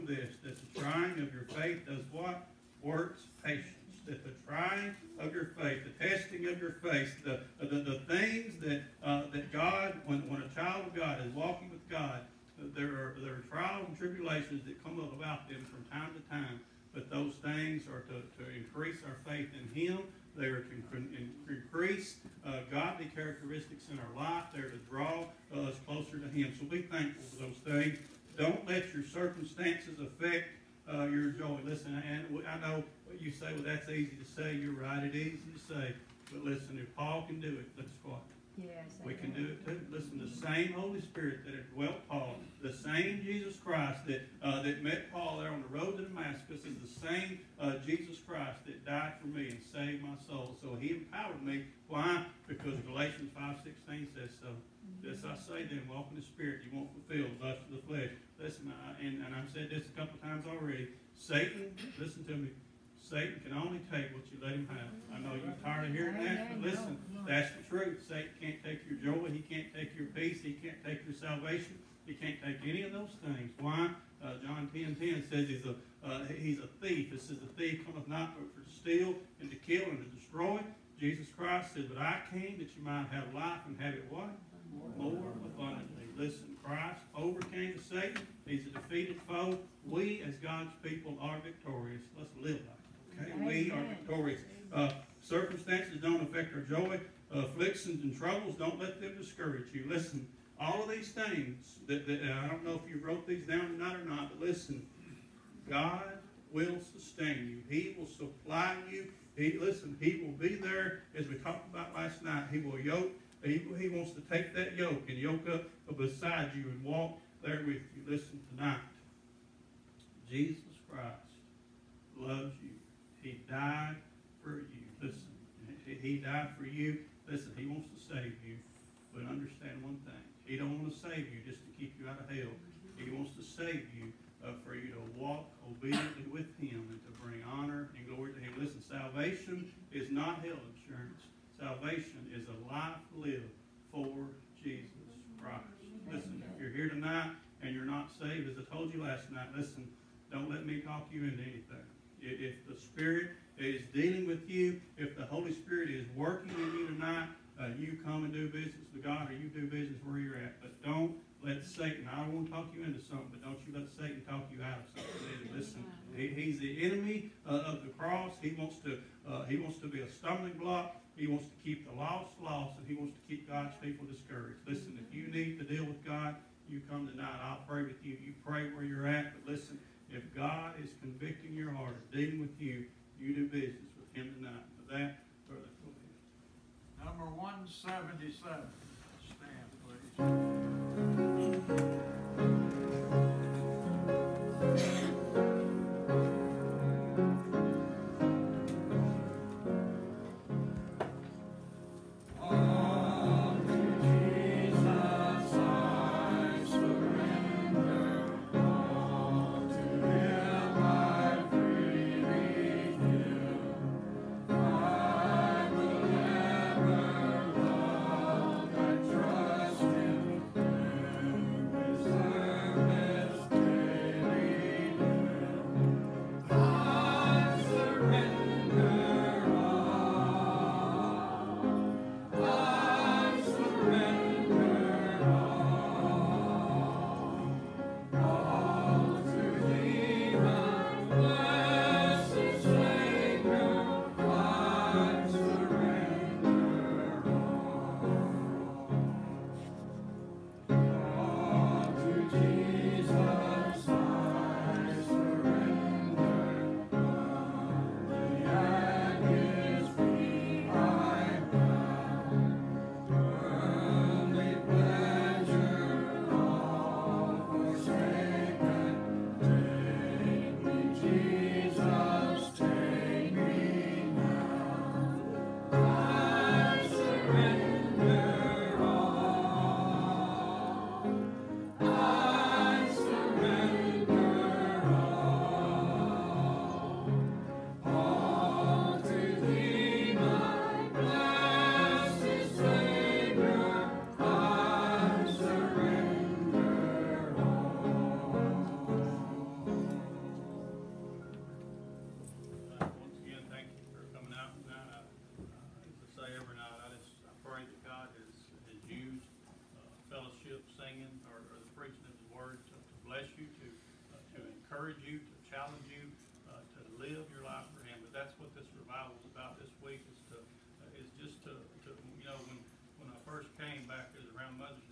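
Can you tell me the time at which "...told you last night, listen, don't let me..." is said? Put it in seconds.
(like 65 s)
148 s.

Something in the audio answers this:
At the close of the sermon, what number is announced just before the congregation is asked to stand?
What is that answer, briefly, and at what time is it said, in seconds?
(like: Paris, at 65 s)
177, at 187 s.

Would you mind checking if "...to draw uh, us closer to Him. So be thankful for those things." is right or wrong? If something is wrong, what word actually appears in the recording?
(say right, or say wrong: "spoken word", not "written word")
right.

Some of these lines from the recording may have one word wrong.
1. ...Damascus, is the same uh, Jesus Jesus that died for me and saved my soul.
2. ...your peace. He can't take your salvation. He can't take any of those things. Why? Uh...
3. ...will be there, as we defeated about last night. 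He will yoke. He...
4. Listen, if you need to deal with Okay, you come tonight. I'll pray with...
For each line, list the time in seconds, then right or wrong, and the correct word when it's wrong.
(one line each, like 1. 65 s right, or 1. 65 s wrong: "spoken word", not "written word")
1. 46 s wrong: "Christ", not "Jesus"
2. 69 s right
3. 110 s wrong: "talked", not "defeated"
4. 174 s wrong: "God", not "Okay".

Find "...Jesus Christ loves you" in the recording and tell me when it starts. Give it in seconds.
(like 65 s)
120 s.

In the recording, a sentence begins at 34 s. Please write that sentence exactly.
You're right, it is easy to say.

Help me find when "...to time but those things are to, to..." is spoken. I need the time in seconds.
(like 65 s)
16 s.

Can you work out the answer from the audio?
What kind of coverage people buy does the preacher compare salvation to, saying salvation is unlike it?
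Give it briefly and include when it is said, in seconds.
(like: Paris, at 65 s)
Health insurance, at 140 s.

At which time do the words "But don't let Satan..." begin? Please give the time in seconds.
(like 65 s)
160 s.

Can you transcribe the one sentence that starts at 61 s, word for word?
Satan, listen to me, Satan can only take what you let him have.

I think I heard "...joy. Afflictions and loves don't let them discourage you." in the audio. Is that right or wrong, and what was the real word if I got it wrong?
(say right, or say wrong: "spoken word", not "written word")
wrong: "troubles", not "loves".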